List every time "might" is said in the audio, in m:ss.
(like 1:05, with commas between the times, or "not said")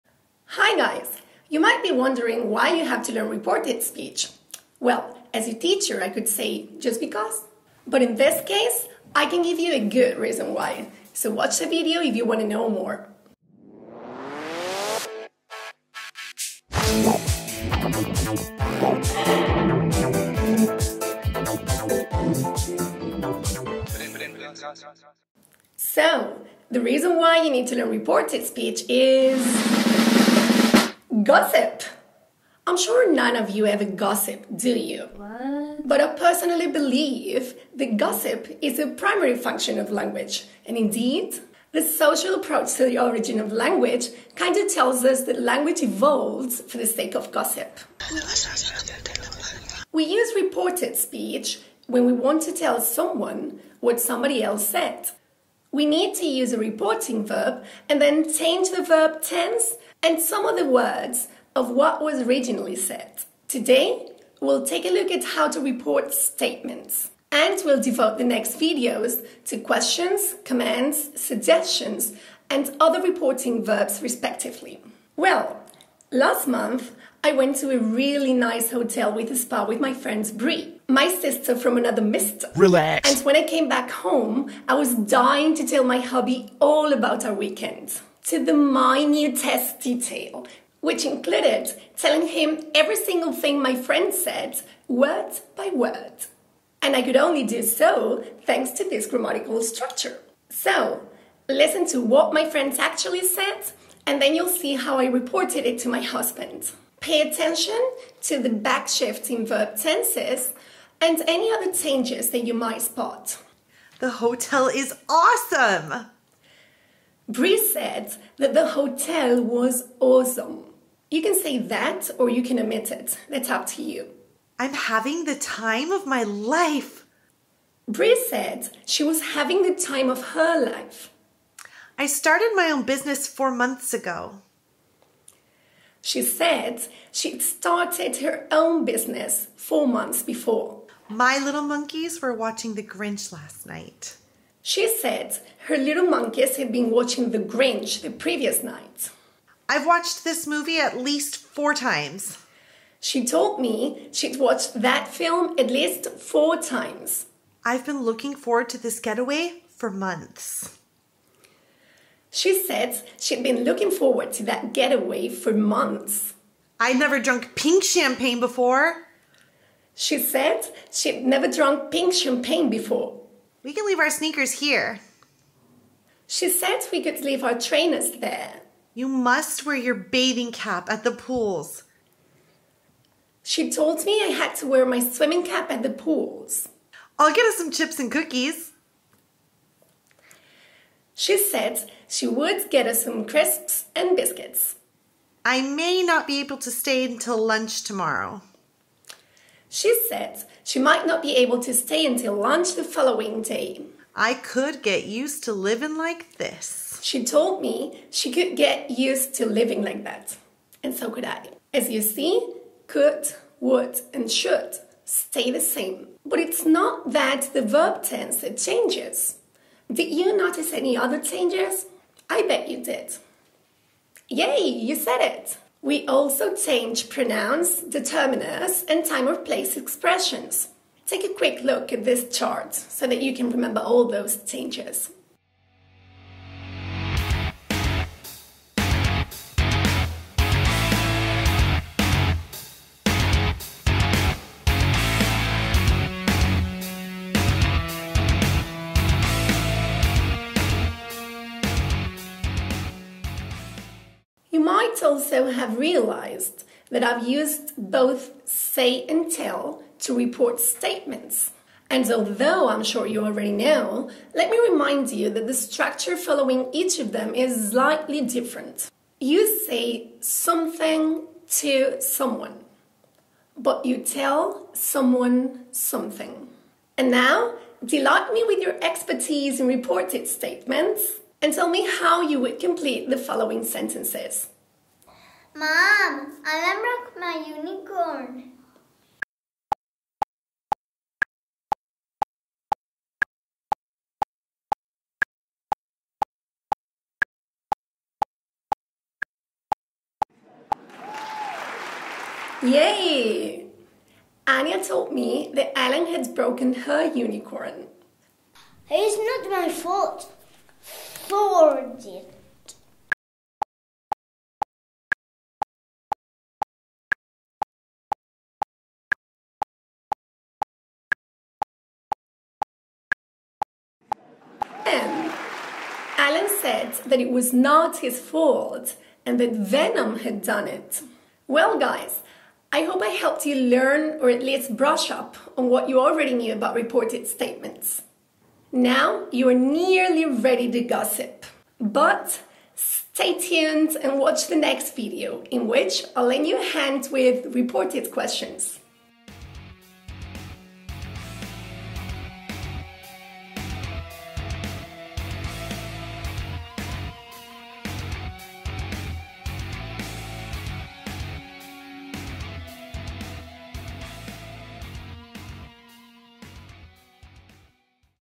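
0:01, 1:52, 3:20, 4:14.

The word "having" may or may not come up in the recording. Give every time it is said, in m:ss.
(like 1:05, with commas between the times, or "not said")
2:04, 2:09.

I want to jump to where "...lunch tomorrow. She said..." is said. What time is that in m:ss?
3:17.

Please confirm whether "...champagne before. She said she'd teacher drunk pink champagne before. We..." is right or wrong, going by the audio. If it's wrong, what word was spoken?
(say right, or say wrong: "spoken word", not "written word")
wrong: "never", not "teacher".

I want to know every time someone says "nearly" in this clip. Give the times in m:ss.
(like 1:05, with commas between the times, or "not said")
5:39.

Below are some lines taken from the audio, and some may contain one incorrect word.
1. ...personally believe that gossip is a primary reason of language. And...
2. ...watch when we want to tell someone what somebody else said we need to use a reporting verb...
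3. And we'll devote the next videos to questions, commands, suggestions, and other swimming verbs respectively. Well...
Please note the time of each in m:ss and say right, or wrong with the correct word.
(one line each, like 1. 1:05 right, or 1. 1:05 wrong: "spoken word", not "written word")
1. 0:36 wrong: "function", not "reason"
2. 0:50 wrong: "speech", not "watch"
3. 1:07 wrong: "reporting", not "swimming".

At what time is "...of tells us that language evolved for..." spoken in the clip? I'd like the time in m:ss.
0:44.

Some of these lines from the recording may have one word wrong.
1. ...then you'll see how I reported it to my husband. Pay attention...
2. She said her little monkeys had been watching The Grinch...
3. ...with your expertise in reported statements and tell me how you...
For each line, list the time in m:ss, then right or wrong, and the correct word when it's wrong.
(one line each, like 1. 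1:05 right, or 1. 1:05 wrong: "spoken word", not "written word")
1. 1:44 right
2. 2:24 right
3. 4:38 right.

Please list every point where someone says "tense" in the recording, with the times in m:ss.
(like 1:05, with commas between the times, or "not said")
0:59, 1:49, 3:38.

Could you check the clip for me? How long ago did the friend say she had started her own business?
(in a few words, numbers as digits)
4 months.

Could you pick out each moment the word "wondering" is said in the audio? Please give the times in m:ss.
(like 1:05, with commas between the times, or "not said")
0:01.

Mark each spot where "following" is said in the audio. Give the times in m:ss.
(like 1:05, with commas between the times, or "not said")
3:22, 4:26, 4:43.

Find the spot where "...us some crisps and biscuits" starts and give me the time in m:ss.
3:12.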